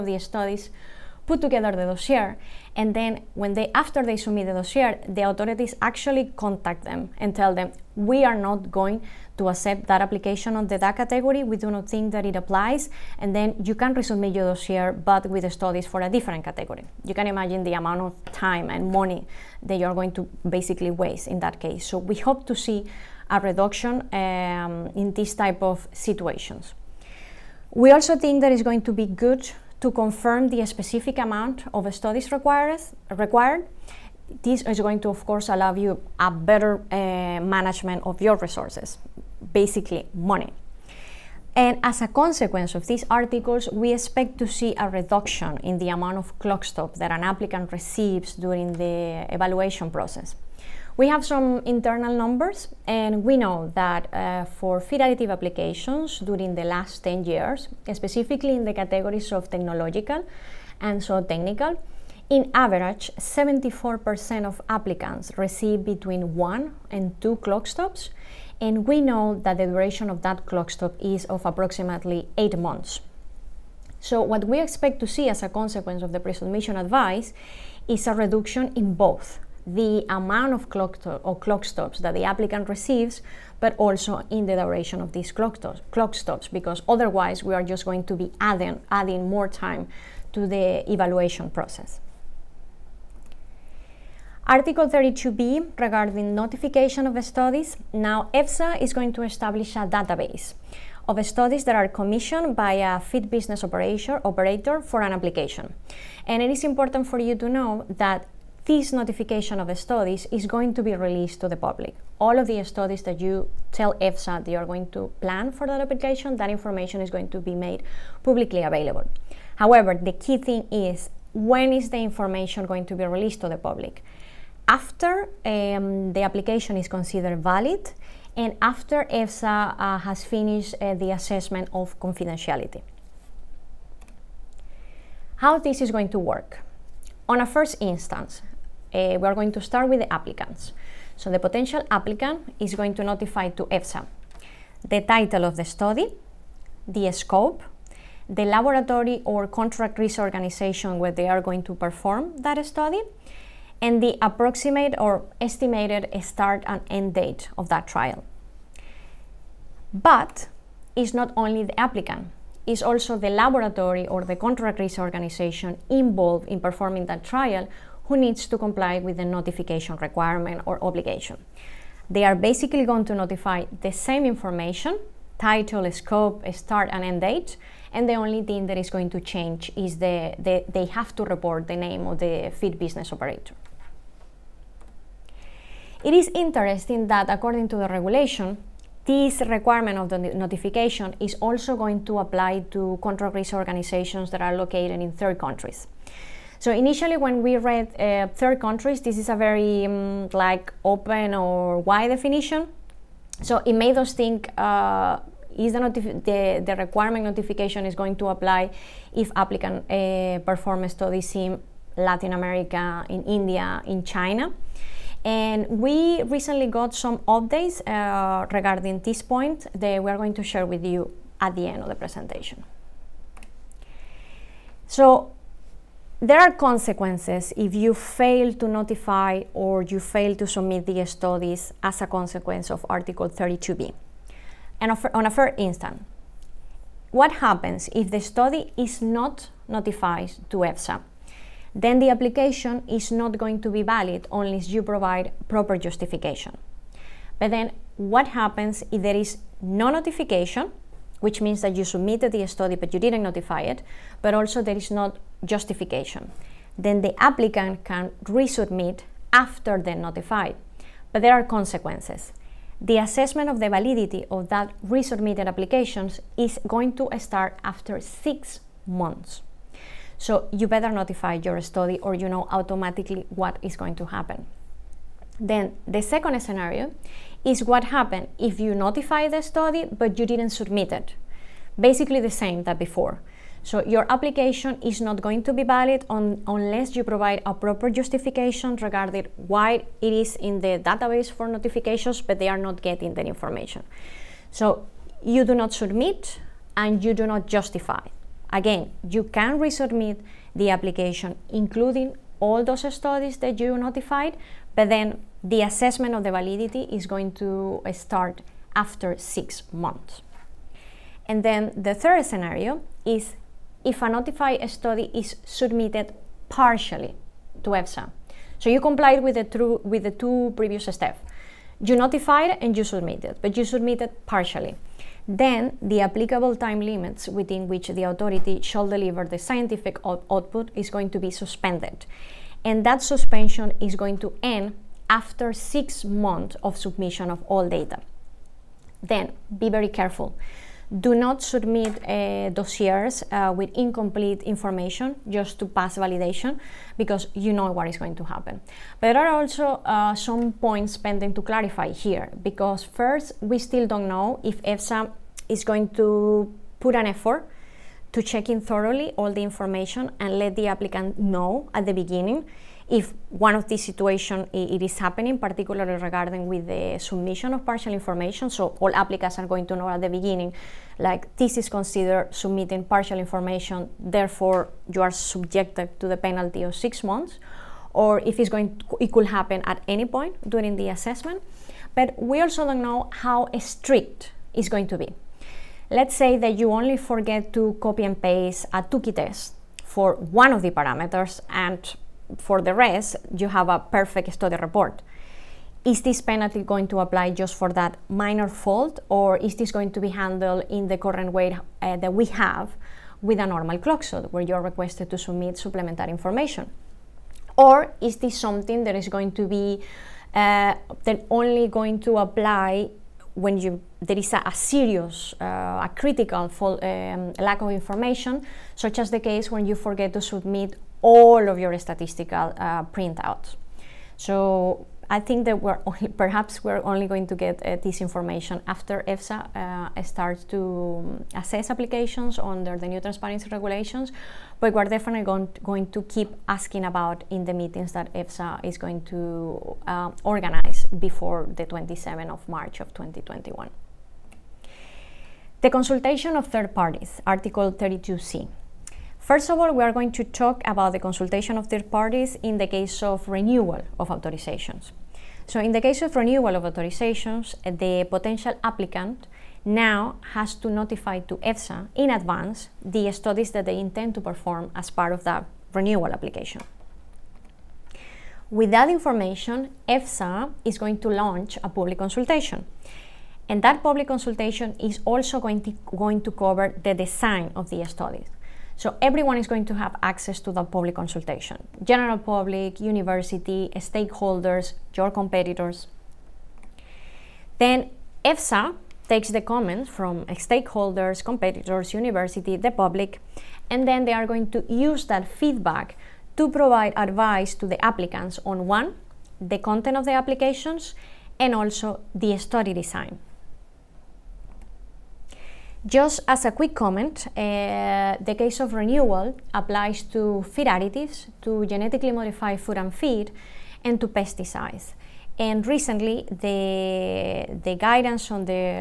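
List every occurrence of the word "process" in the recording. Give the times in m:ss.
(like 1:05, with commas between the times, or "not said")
0:49, 1:31.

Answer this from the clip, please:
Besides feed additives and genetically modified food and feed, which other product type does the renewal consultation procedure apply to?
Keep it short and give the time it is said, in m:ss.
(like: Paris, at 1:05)
pesticides, at 8:34.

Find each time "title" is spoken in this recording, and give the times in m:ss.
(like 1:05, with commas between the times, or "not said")
2:25, 2:55.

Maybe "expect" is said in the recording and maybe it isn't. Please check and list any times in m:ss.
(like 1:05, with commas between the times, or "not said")
0:43, 1:14.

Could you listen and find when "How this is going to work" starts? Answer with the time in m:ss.
2:15.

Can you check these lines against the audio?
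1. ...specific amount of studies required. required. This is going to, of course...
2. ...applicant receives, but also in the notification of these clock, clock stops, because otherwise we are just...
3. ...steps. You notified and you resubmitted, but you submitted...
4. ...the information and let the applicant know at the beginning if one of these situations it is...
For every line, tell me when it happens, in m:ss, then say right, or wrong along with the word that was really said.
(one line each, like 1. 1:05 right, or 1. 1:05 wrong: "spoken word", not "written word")
1. 0:30 right
2. 1:22 wrong: "duration", not "notification"
3. 5:20 wrong: "submitted", not "resubmitted"
4. 5:59 right.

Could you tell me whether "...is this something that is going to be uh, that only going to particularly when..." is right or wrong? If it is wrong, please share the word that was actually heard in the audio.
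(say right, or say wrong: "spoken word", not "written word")
wrong: "apply", not "particularly".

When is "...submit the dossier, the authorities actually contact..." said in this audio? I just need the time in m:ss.
0:04.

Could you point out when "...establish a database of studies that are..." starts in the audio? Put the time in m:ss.
1:39.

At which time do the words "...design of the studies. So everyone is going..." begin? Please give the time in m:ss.
7:56.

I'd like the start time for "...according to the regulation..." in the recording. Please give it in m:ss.
3:07.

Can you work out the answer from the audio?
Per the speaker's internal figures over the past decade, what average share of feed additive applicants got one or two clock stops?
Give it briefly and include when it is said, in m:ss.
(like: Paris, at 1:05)
74%, at 1:03.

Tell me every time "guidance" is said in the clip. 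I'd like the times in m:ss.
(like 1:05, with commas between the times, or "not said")
8:37.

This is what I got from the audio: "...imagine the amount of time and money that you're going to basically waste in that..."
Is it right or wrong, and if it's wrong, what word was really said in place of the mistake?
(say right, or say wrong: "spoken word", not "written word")
right.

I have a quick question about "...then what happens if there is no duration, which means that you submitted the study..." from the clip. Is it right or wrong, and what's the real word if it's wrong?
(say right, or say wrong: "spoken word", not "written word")
wrong: "notification", not "duration".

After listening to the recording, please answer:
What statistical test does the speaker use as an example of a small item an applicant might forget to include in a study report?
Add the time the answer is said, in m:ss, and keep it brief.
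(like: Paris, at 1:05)
Tukey test, at 6:28.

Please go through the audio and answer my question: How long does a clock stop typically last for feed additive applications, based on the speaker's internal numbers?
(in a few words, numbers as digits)
8 months.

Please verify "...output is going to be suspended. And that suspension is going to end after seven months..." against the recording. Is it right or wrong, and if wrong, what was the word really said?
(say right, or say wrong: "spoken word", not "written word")
wrong: "six", not "seven".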